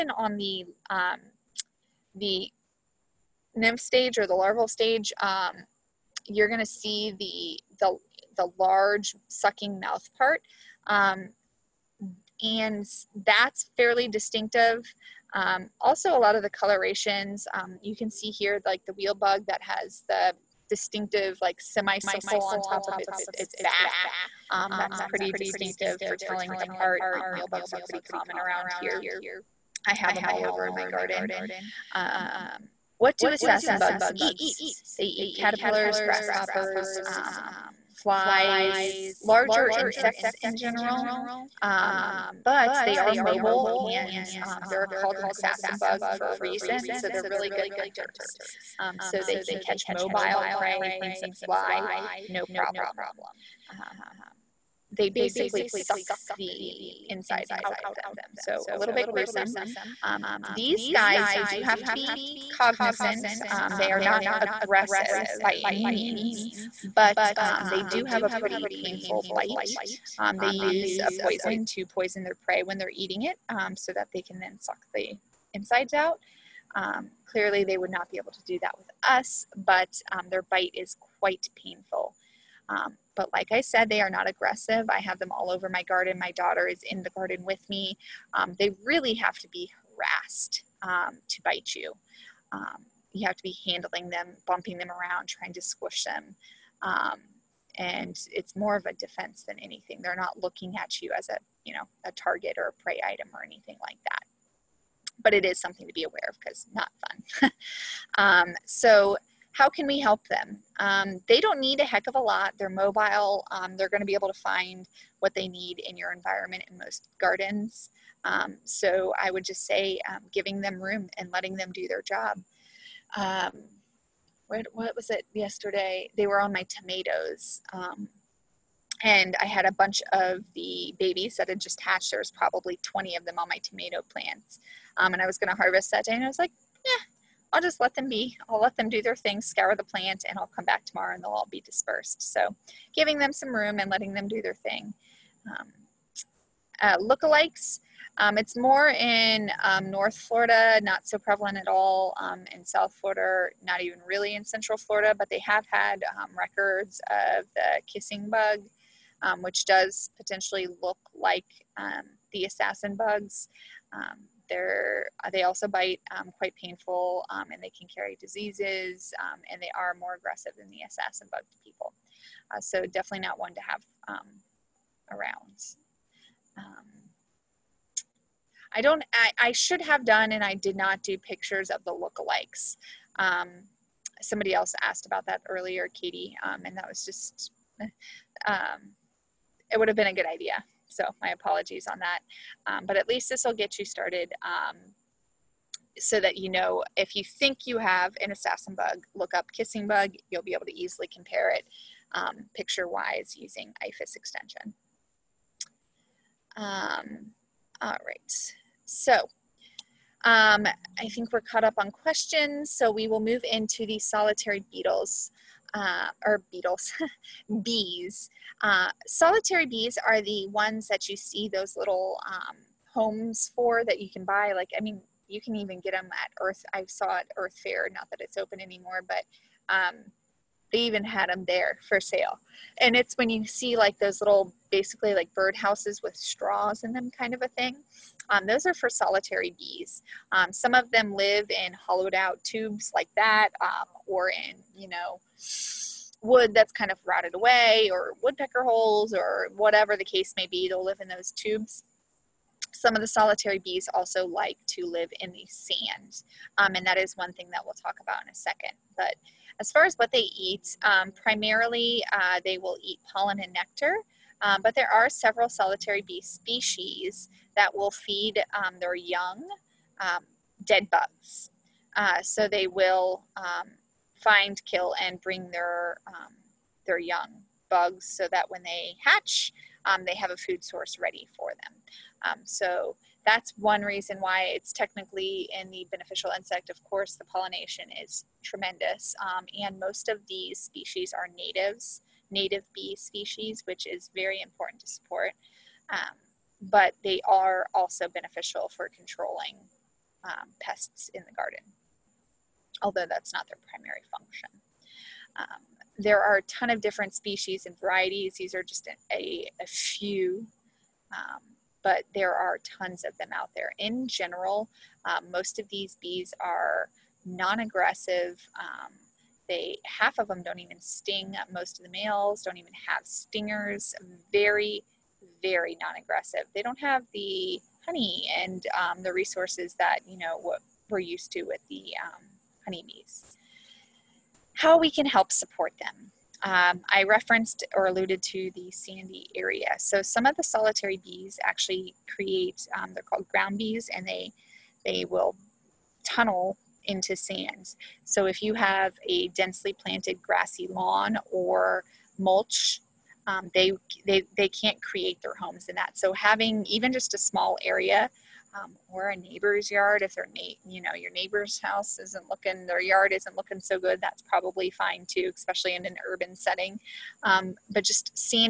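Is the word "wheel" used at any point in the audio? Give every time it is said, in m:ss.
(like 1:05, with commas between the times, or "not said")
0:18, 0:27.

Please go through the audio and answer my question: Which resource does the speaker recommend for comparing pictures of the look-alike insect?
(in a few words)
IFAS extension.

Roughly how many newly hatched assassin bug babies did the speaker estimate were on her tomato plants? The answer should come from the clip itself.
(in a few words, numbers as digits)
20.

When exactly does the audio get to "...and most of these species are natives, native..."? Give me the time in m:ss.
4:49.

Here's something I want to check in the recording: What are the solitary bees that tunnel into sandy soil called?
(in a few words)
Ground bees.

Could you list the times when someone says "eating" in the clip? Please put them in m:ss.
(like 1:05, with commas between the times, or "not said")
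1:12.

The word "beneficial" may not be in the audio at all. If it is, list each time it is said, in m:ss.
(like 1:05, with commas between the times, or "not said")
4:45, 4:58.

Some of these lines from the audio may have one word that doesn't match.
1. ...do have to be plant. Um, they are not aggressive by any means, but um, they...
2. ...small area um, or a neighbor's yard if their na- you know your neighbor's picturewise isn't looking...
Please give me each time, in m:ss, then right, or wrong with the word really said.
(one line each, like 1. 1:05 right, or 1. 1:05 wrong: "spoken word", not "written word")
1. 1:01 wrong: "cognizant", not "plant"
2. 5:57 wrong: "house", not "picturewise".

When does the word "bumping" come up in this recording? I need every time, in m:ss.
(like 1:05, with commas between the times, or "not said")
1:34.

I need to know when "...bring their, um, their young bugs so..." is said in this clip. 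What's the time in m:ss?
4:35.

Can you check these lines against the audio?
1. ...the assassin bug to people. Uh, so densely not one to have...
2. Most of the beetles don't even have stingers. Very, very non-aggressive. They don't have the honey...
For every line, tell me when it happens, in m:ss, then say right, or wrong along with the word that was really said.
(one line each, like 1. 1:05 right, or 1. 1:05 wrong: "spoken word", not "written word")
1. 2:50 wrong: "definitely", not "densely"
2. 5:21 wrong: "males", not "beetles".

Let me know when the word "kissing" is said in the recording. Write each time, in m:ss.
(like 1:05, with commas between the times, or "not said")
2:37, 3:19.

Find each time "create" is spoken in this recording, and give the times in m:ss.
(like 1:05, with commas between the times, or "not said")
5:42, 5:54.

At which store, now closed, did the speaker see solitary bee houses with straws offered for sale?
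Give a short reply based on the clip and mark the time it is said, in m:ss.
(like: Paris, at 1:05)
Earth Fare, at 3:47.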